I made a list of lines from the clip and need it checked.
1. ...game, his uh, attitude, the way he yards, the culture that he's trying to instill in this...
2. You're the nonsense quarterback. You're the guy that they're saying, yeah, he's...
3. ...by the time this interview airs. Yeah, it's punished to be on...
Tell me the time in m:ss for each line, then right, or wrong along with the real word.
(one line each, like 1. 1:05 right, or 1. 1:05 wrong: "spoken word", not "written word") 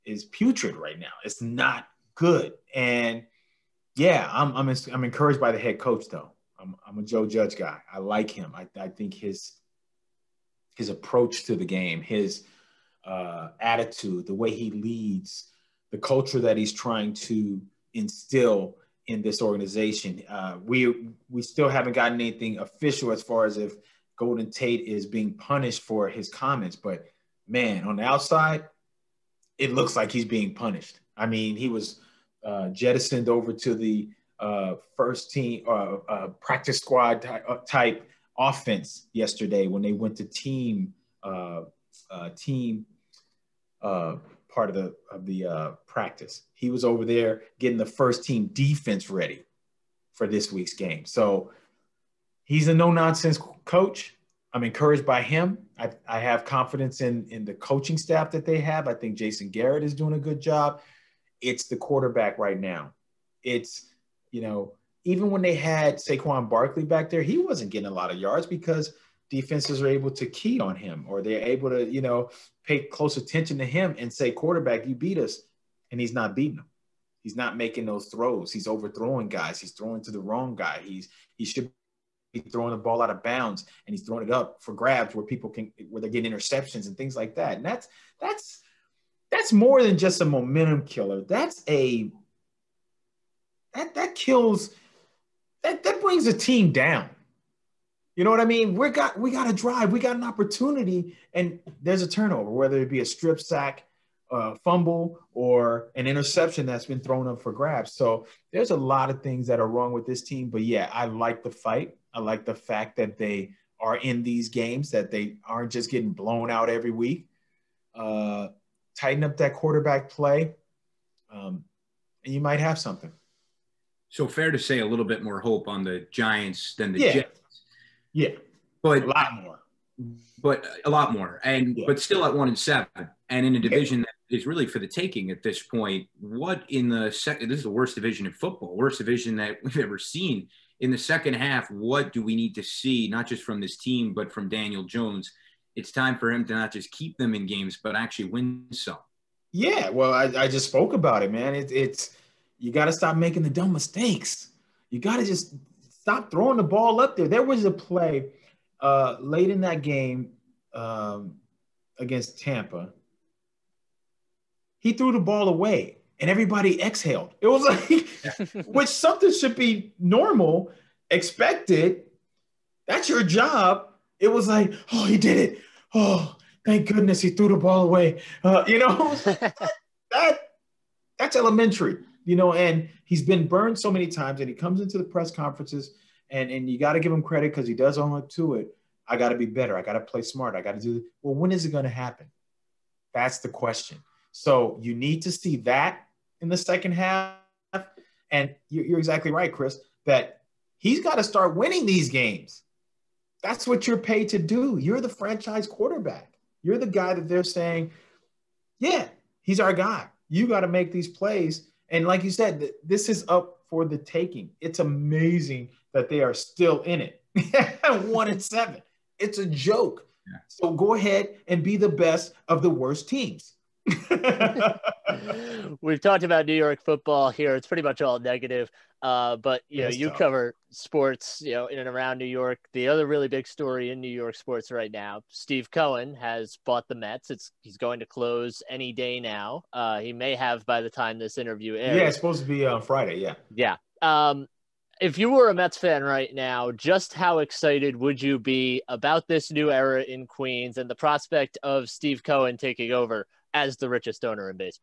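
1. 0:11 wrong: "leads", not "yards"
2. 3:24 wrong: "franchise", not "nonsense"
3. 4:00 wrong: "supposed", not "punished".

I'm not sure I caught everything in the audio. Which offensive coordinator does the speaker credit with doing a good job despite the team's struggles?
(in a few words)
Jason Garrett.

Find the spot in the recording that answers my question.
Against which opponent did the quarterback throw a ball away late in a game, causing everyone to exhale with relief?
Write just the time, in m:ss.
2:42.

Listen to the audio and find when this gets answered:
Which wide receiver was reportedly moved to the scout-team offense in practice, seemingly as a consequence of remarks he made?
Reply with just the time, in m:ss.
0:24.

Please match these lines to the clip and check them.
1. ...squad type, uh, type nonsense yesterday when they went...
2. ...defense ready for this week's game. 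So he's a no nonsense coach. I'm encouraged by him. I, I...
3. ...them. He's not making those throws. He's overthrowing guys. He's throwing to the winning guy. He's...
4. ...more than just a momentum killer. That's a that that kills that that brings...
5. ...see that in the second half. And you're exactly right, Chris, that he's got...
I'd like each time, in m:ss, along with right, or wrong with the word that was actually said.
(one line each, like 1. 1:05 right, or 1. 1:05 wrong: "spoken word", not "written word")
1. 0:36 wrong: "offense", not "nonsense"
2. 0:48 right
3. 1:16 wrong: "wrong", not "winning"
4. 1:29 right
5. 3:15 right.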